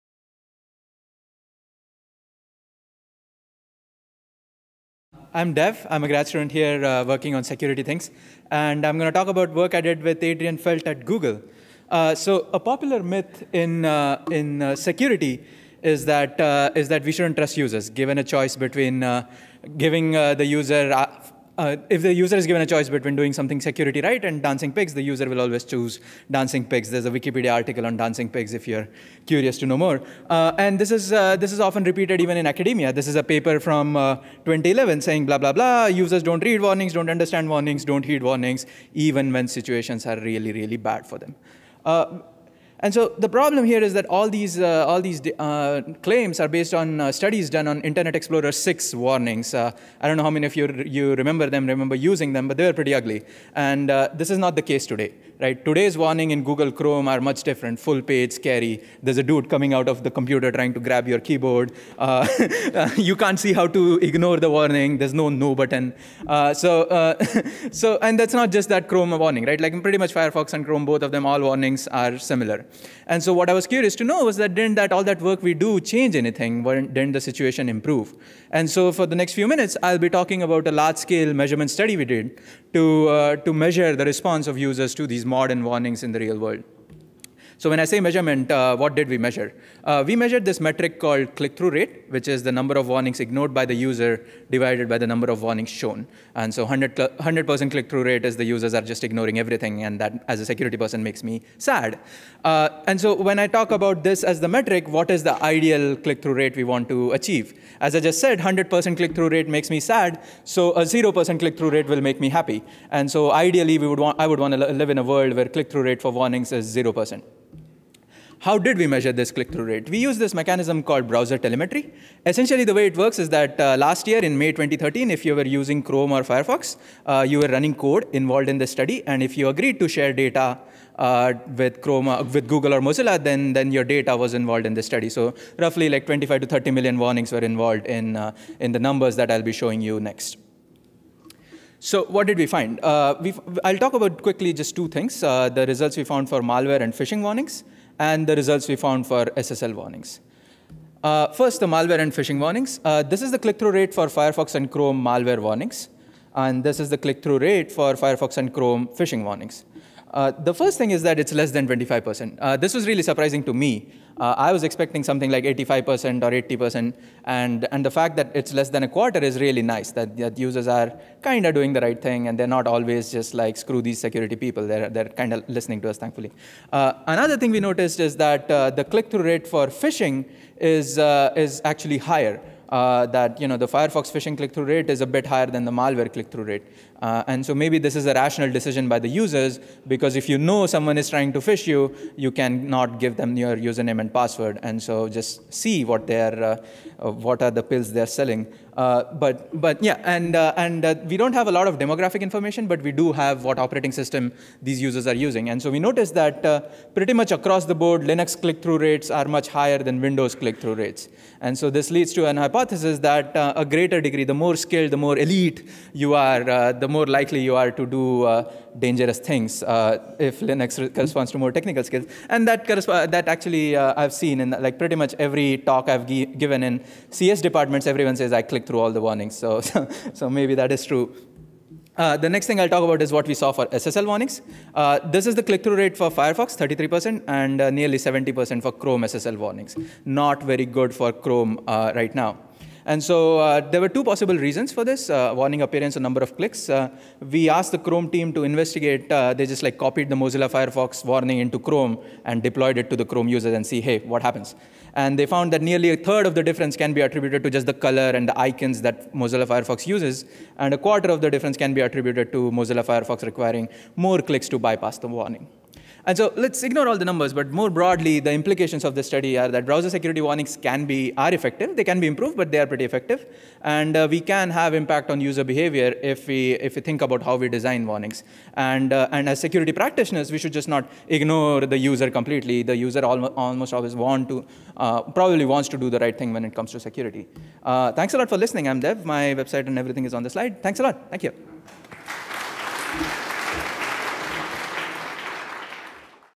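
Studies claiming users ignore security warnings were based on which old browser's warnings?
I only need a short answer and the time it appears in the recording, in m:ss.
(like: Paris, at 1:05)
Internet Explorer 6, at 0:47.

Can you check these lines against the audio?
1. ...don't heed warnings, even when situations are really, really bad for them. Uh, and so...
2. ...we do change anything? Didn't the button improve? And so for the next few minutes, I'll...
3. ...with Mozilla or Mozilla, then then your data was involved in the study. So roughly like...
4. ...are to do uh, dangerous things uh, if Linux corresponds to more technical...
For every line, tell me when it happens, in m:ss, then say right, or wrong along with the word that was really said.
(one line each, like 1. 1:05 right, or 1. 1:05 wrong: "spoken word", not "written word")
1. 0:37 right
2. 1:15 wrong: "situation", not "button"
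3. 2:12 wrong: "Google", not "Mozilla"
4. 3:37 right.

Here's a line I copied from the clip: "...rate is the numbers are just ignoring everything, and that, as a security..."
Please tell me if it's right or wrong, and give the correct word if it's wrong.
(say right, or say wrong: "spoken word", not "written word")
wrong: "users", not "numbers".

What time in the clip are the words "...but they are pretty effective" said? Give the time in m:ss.
4:32.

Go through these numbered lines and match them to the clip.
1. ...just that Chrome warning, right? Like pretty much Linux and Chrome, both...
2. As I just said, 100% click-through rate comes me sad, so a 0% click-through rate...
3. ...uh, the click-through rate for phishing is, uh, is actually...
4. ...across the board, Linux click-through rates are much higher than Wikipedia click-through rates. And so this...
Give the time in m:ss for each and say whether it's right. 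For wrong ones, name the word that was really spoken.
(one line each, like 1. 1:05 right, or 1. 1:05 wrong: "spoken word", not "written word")
1. 1:08 wrong: "Firefox", not "Linux"
2. 1:47 wrong: "makes", not "comes"
3. 2:58 right
4. 3:27 wrong: "Windows", not "Wikipedia".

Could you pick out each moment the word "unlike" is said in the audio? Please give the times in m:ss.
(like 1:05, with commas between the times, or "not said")
not said.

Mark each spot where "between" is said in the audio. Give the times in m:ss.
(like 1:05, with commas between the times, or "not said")
0:18, 0:22.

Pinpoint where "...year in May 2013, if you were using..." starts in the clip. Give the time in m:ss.
2:04.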